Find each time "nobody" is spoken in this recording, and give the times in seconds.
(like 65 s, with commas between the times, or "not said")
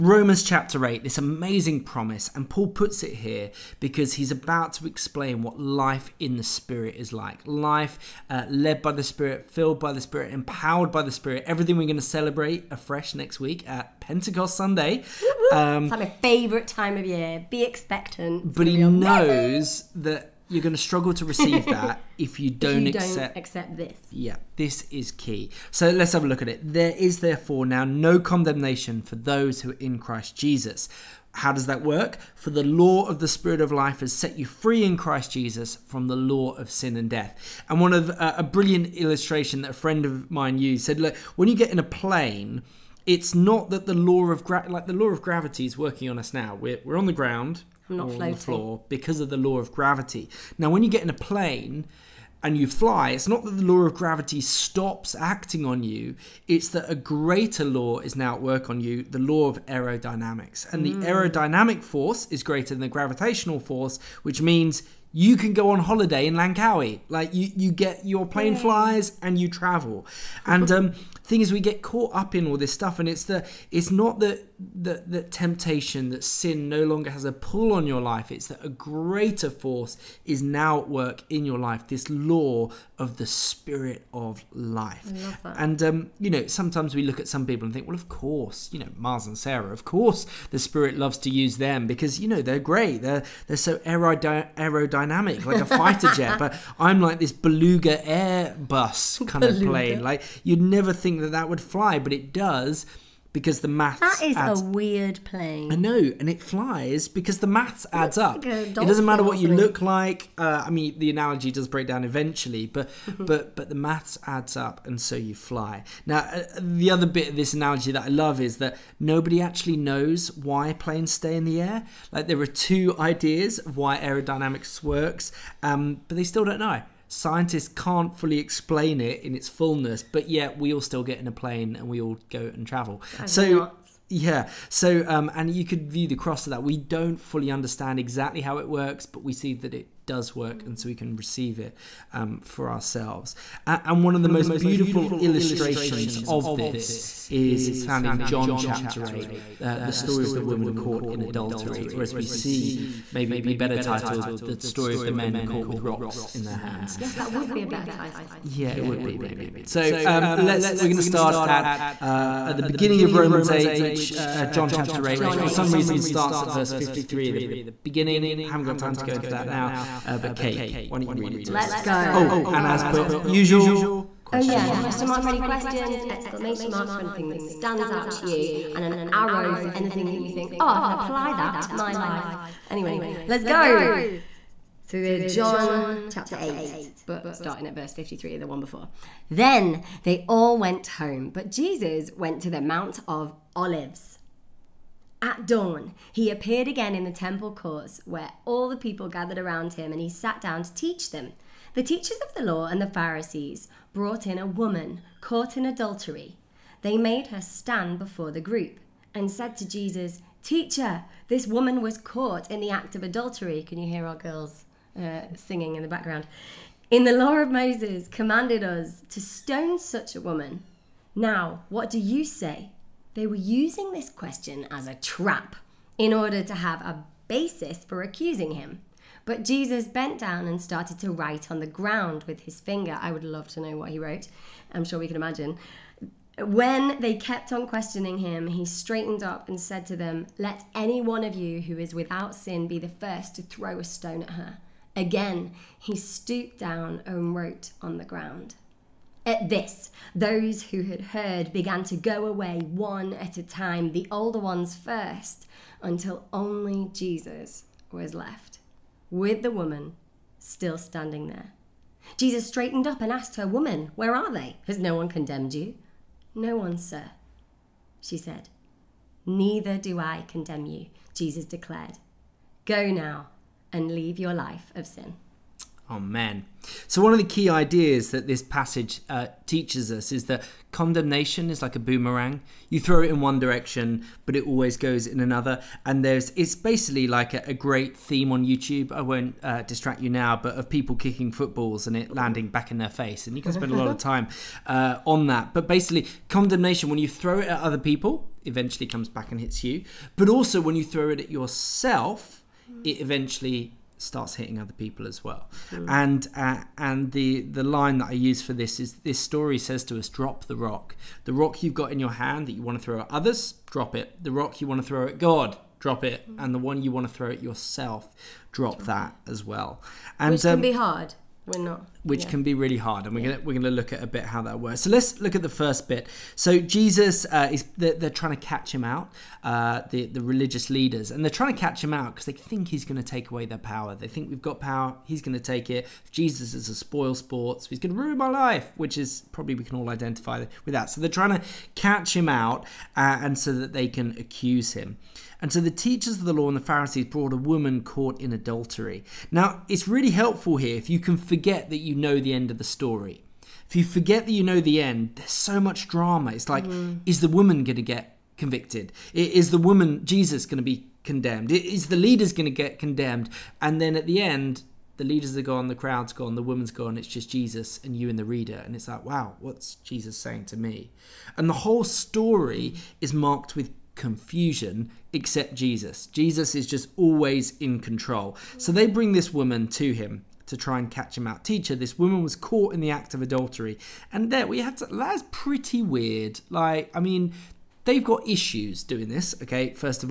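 118 s.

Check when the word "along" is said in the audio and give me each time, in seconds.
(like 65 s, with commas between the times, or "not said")
not said.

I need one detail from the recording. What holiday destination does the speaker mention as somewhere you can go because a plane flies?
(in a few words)
Langkawi.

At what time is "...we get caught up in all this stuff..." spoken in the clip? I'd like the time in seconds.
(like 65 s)
71 s.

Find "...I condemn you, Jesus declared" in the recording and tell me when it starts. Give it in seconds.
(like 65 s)
269 s.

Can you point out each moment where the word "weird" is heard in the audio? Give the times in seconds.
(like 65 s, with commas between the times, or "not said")
104 s, 385 s.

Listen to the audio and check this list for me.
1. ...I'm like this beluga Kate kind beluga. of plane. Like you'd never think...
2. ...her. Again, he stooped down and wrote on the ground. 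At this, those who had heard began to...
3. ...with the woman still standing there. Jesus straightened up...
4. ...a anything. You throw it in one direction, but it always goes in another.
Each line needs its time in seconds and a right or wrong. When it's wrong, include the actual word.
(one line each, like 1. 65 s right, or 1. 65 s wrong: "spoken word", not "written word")
1. 96 s wrong: "Airbus", not "Kate"
2. 244 s right
3. 259 s right
4. 281 s wrong: "boomerang", not "anything".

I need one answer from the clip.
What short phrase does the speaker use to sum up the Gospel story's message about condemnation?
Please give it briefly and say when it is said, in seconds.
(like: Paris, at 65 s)
Drop the rock, at 310 s.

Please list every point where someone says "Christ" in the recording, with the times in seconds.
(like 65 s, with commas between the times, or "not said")
29 s, 34 s.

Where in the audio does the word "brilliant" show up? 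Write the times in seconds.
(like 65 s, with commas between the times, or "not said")
38 s.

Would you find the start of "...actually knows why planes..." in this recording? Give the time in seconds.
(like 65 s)
119 s.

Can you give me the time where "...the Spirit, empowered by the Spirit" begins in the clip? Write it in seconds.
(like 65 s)
9 s.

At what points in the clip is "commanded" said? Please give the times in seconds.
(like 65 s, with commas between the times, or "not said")
218 s.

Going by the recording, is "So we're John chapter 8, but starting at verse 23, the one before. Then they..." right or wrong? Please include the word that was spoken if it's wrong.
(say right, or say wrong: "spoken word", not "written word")
wrong: "53", not "23".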